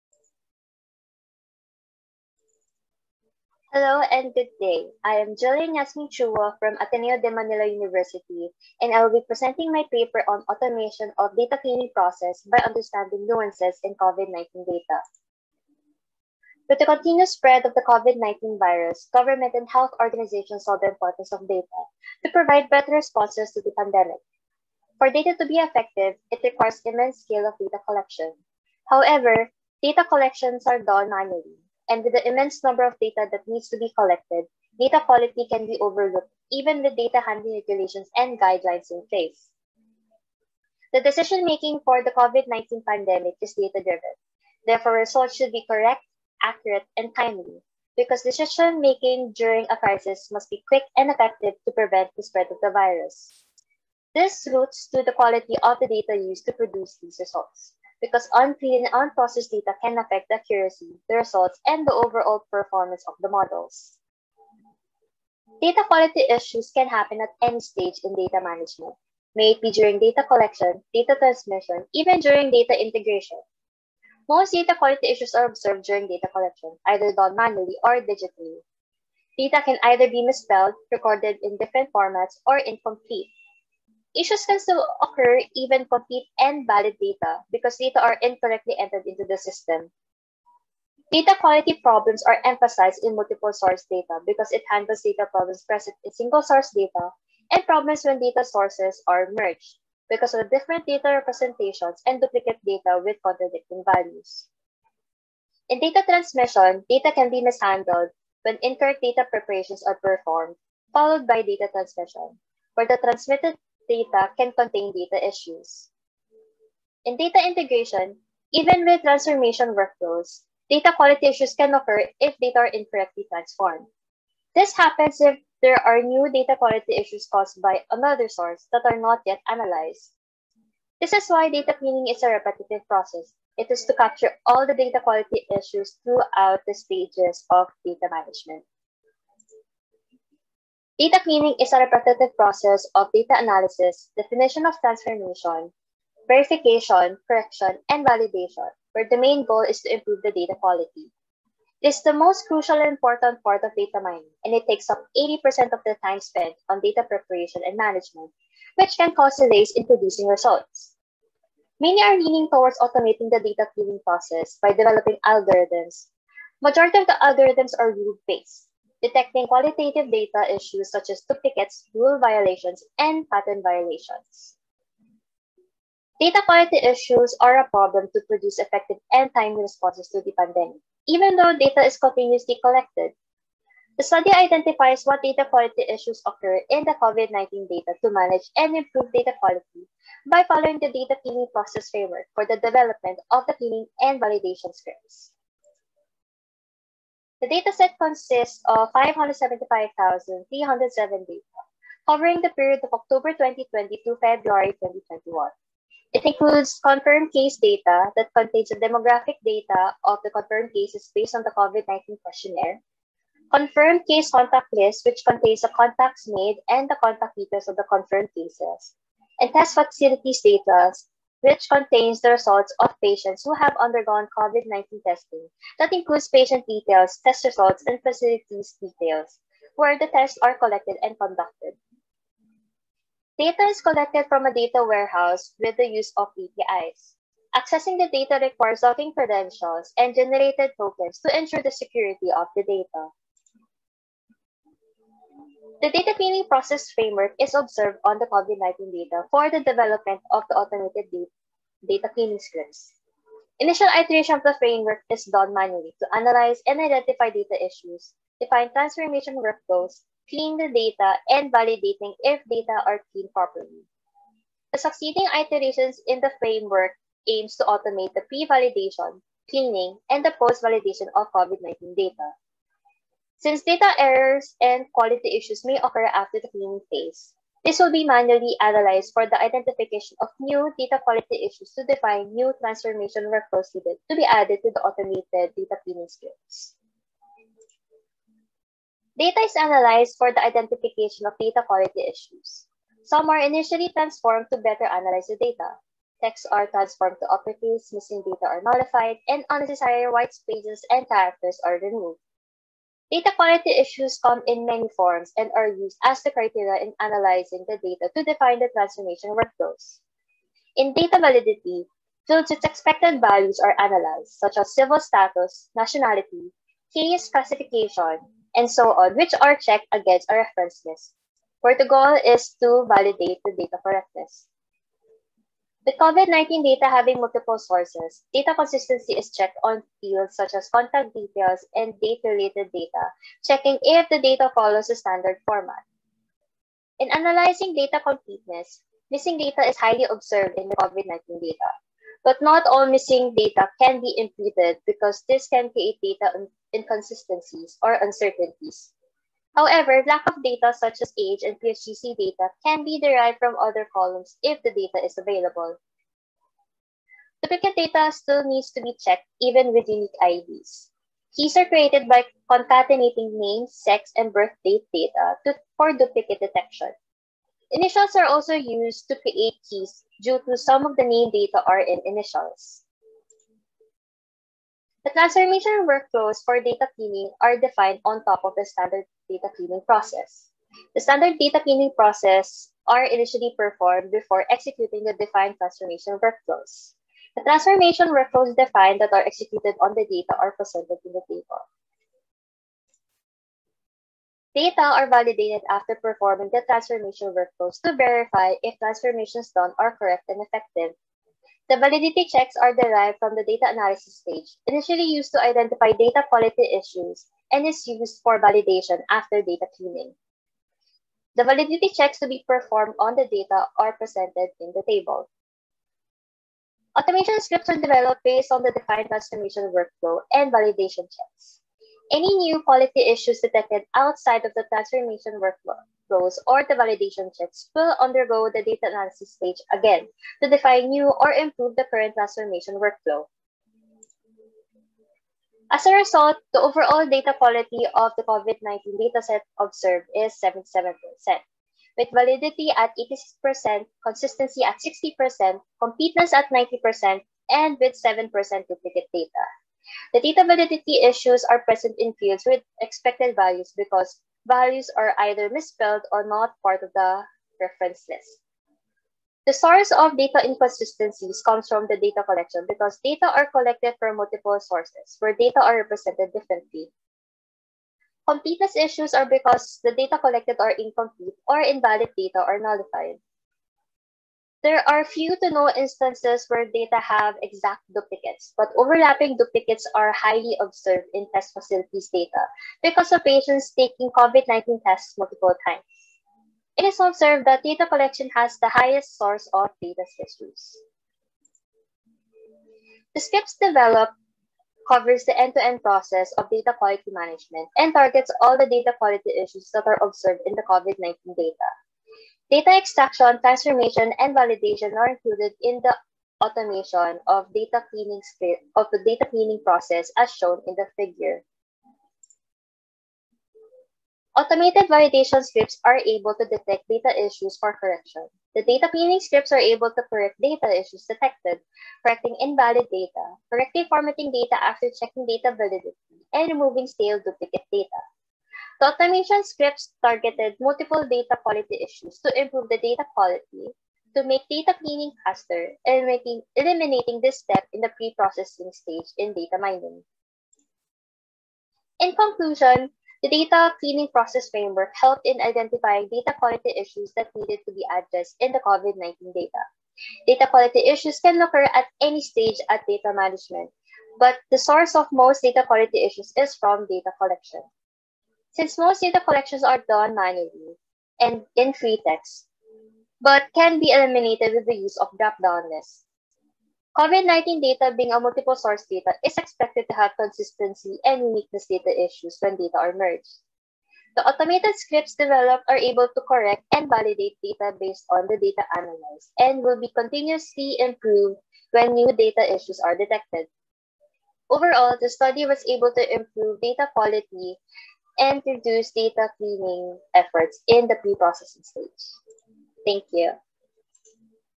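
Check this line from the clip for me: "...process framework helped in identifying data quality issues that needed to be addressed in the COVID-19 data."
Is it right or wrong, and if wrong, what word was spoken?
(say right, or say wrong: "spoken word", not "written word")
right.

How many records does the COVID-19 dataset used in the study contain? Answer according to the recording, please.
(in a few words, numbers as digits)
575,307.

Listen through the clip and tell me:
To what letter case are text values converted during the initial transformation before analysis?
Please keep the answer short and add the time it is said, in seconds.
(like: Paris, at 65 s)
uppercase, at 297 s.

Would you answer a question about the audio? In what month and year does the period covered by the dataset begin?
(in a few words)
October 2020.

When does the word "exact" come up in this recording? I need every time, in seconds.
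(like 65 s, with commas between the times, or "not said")
477 s.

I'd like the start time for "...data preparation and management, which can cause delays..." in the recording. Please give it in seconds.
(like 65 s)
156 s.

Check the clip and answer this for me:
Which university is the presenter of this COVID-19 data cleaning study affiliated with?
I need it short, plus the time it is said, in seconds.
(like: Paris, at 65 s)
Ateneo de Manila University, at 6 s.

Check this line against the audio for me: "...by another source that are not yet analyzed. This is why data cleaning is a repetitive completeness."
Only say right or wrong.
wrong.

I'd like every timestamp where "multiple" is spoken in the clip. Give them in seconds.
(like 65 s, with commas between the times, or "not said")
93 s, 327 s, 464 s, 485 s, 530 s, 568 s.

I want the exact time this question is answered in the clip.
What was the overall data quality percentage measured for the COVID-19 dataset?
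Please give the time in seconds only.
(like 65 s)
440 s.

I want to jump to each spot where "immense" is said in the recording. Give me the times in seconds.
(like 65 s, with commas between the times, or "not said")
26 s, 32 s.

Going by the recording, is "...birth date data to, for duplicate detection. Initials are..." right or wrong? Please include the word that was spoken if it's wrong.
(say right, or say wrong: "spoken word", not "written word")
right.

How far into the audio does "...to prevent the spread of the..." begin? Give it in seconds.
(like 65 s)
51 s.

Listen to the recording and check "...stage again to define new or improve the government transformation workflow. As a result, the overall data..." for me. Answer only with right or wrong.
wrong.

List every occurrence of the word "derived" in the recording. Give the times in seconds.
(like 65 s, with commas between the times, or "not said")
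353 s, 402 s.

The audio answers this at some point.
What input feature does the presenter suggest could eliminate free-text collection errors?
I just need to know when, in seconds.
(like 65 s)
565 s.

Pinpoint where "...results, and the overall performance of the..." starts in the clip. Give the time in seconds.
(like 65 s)
61 s.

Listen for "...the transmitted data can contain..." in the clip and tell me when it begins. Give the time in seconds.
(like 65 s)
112 s.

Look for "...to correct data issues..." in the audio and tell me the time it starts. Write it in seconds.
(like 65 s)
519 s.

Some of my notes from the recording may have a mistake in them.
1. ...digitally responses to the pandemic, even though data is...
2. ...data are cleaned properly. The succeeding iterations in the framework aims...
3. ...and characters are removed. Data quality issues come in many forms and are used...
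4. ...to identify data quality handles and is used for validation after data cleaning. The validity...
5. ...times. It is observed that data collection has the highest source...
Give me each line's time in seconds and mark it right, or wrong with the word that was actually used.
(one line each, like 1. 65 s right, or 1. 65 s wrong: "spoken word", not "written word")
1. 179 s wrong: "timely", not "digitally"
2. 262 s right
3. 300 s right
4. 405 s wrong: "issues", not "handles"
5. 485 s right.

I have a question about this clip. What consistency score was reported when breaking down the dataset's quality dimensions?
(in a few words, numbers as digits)
60%.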